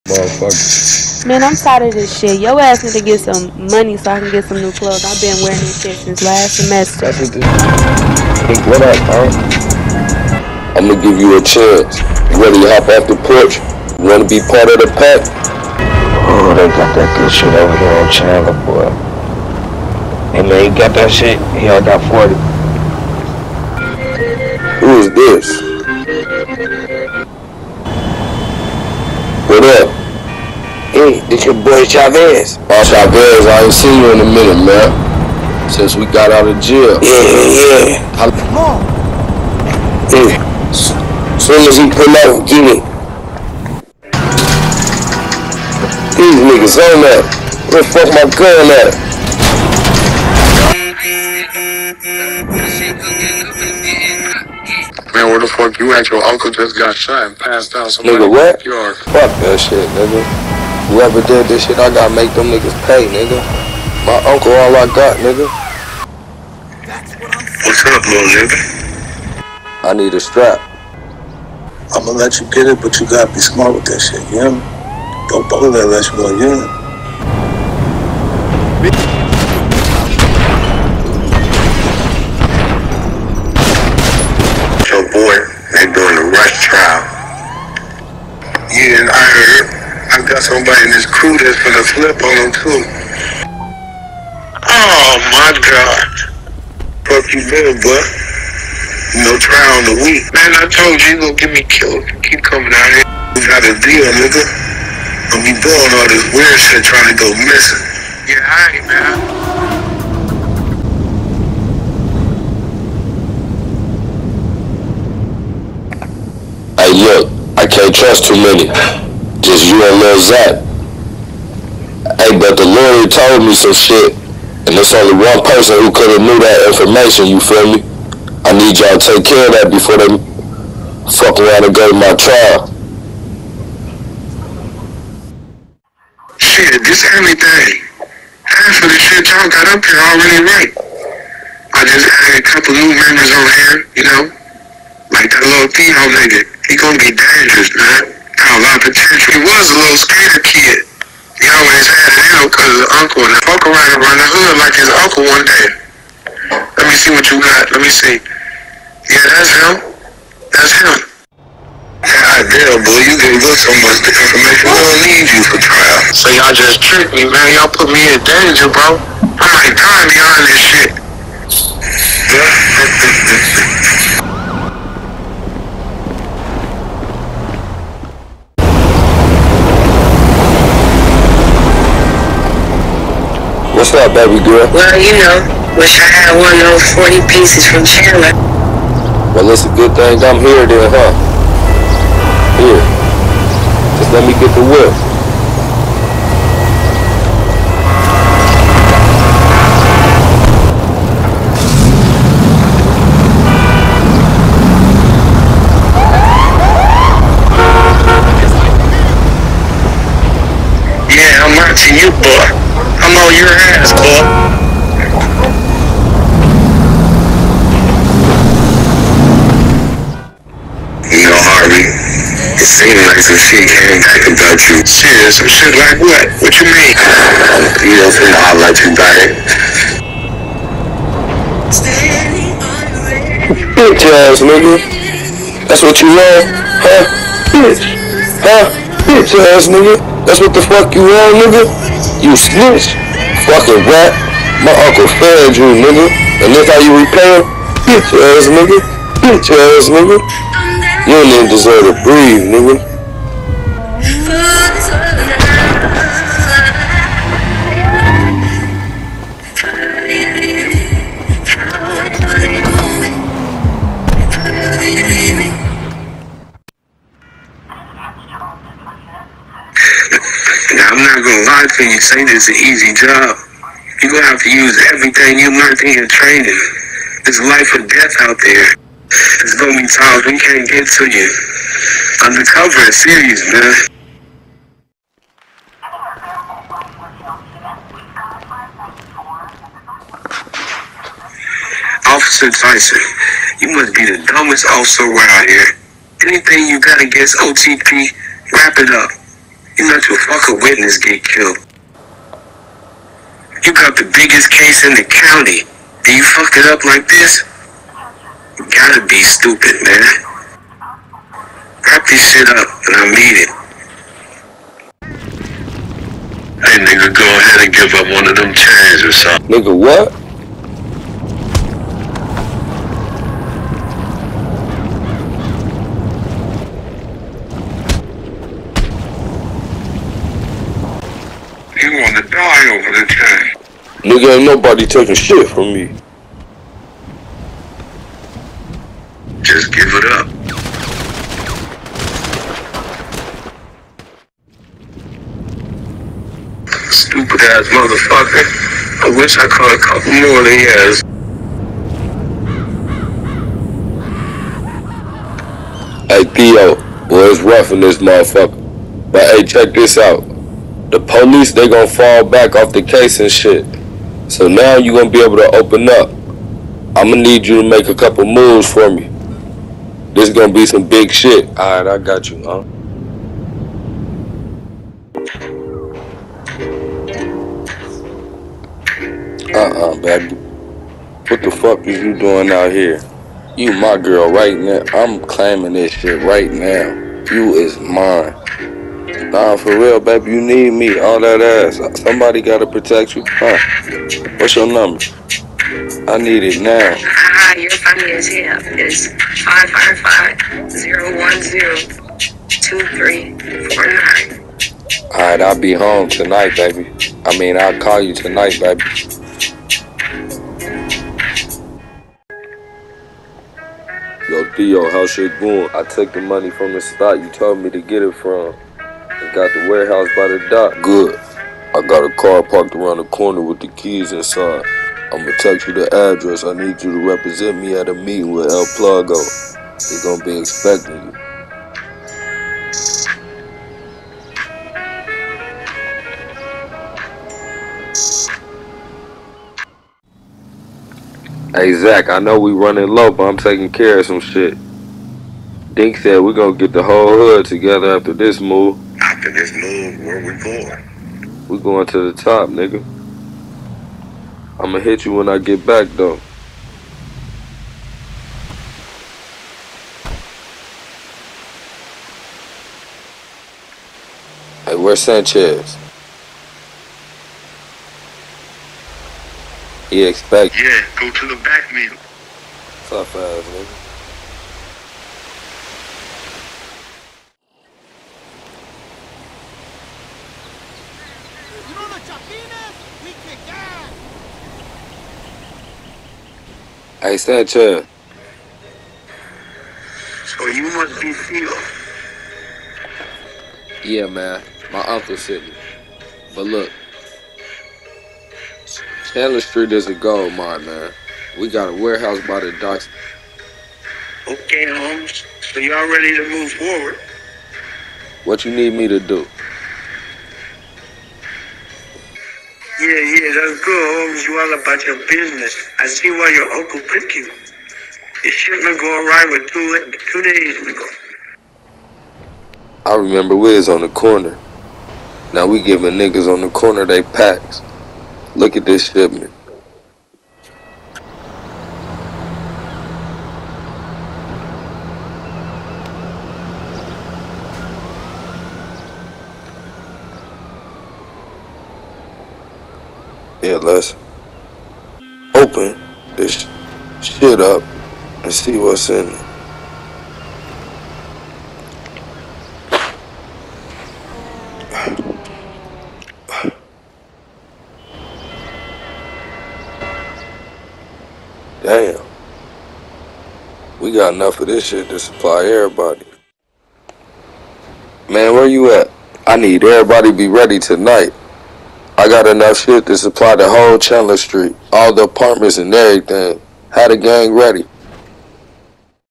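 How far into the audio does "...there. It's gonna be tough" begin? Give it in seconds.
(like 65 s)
278 s.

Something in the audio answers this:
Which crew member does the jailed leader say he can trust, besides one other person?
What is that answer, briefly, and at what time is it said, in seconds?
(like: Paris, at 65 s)
Lil Zap, at 119 s.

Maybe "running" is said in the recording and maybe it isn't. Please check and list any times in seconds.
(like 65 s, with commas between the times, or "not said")
442 s.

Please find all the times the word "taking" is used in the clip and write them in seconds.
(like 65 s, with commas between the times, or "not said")
334 s, 443 s.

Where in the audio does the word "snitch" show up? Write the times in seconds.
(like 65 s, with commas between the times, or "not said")
242 s.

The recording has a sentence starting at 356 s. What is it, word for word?
Hey Theo, boy, it's rough in this motherfucker.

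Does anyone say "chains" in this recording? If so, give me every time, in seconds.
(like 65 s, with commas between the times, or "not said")
318 s, 333 s.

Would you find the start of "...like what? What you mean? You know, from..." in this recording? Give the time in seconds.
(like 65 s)
225 s.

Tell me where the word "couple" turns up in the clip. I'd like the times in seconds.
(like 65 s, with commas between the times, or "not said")
142 s, 349 s, 367 s.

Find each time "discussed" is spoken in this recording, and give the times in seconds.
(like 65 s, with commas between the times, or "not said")
not said.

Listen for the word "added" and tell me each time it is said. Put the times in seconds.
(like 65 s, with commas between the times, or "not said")
142 s.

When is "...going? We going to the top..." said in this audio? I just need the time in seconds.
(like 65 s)
450 s.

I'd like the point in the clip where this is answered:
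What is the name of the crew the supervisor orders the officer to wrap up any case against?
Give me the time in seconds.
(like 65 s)
297 s.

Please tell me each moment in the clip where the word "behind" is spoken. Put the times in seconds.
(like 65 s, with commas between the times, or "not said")
170 s.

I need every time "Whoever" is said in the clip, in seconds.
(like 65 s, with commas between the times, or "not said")
60 s.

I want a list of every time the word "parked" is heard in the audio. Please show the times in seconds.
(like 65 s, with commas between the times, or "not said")
422 s.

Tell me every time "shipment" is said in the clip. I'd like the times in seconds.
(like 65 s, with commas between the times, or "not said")
518 s, 528 s.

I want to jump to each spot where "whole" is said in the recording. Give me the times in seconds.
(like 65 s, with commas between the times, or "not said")
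446 s, 573 s.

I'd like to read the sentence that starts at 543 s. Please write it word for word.
Yeah, let's open this shit up and see what's in it.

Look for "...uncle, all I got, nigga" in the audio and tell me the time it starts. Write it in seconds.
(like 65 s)
64 s.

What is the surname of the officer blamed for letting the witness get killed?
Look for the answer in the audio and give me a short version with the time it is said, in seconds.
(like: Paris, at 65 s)
Tyson, at 292 s.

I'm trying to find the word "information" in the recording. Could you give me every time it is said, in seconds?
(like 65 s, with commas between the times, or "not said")
126 s, 164 s.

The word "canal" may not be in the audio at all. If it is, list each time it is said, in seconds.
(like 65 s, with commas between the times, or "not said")
not said.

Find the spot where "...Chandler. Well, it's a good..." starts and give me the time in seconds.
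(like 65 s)
187 s.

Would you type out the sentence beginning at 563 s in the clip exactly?
We got enough of this shit to supply everybody.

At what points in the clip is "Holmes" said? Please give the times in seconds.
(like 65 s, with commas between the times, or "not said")
504 s, 514 s.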